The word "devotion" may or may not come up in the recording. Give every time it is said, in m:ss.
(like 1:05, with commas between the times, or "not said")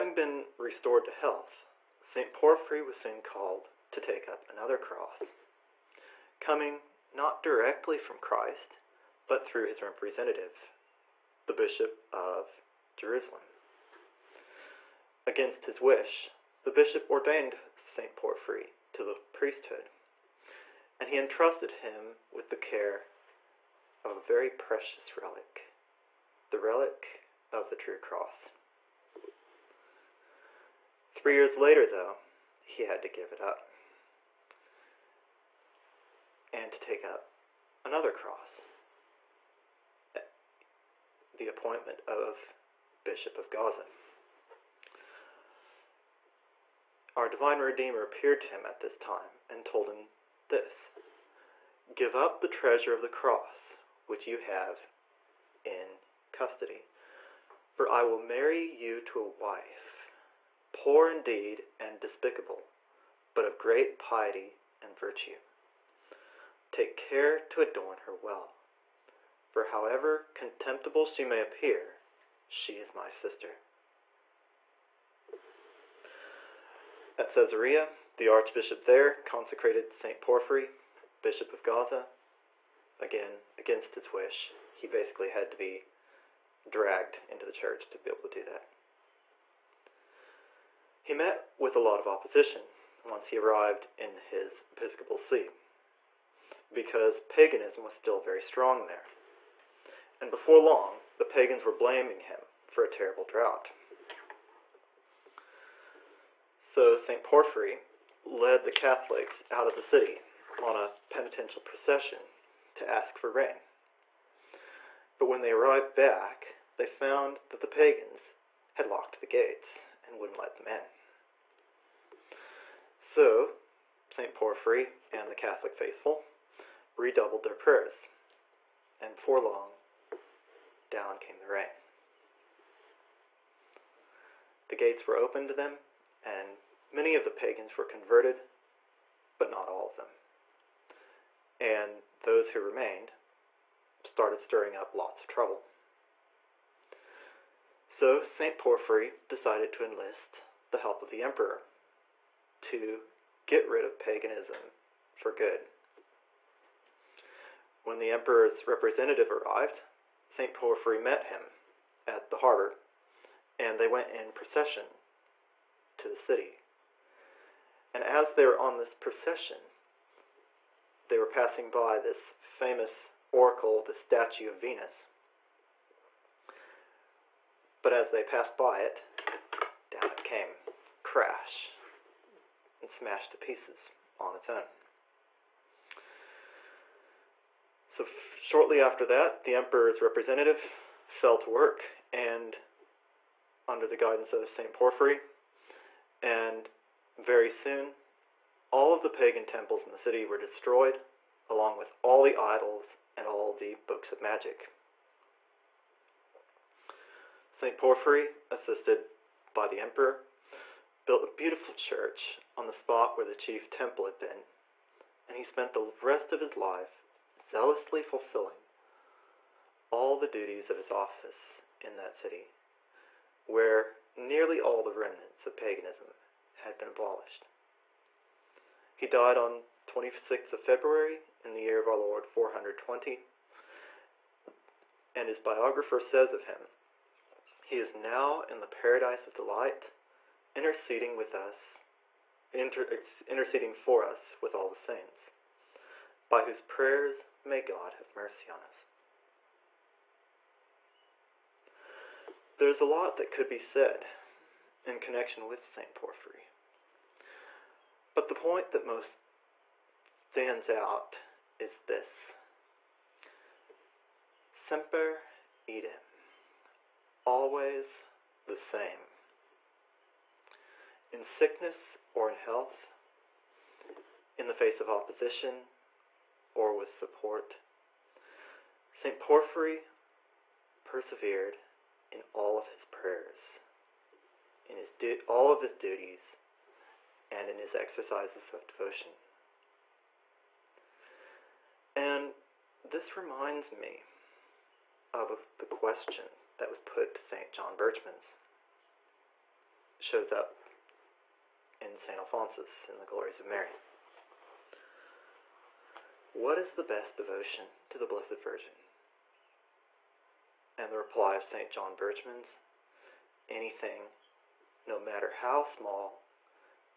4:48, 5:07.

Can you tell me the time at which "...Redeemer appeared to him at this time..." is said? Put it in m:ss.
0:47.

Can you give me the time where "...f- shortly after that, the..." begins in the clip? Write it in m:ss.
3:08.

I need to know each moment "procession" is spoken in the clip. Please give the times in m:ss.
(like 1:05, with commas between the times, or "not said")
1:51, 2:44, 2:48.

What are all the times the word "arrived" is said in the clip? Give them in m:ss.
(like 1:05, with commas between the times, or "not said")
1:33, 1:55, 2:39.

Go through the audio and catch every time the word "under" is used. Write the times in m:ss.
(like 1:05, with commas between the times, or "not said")
3:13.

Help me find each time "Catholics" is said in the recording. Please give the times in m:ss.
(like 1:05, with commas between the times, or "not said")
1:48, 2:05.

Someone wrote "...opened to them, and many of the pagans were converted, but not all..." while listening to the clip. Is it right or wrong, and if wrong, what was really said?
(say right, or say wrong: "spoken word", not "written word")
right.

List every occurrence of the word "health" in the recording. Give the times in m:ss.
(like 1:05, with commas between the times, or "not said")
0:01, 4:32.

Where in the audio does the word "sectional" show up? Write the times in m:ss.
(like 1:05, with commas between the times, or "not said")
not said.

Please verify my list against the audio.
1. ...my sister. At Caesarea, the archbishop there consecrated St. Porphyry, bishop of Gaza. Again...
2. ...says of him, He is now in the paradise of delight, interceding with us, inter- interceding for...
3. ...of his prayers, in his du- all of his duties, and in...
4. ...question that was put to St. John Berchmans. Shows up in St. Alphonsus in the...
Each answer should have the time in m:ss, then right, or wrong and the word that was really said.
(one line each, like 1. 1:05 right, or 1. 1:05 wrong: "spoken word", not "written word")
1. 1:12 right
2. 3:55 right
3. 4:42 right
4. 4:55 right.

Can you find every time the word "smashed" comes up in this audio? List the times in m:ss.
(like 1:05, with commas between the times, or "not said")
3:02.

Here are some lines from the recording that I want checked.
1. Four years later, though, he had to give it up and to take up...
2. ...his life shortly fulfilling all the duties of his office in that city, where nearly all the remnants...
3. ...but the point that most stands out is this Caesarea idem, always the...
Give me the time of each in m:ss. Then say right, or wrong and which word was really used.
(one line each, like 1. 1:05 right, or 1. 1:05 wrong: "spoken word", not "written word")
1. 0:31 wrong: "Three", not "Four"
2. 3:36 wrong: "zealously", not "shortly"
3. 4:18 wrong: "Semper", not "Caesarea".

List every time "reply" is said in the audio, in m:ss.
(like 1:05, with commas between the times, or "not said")
5:10.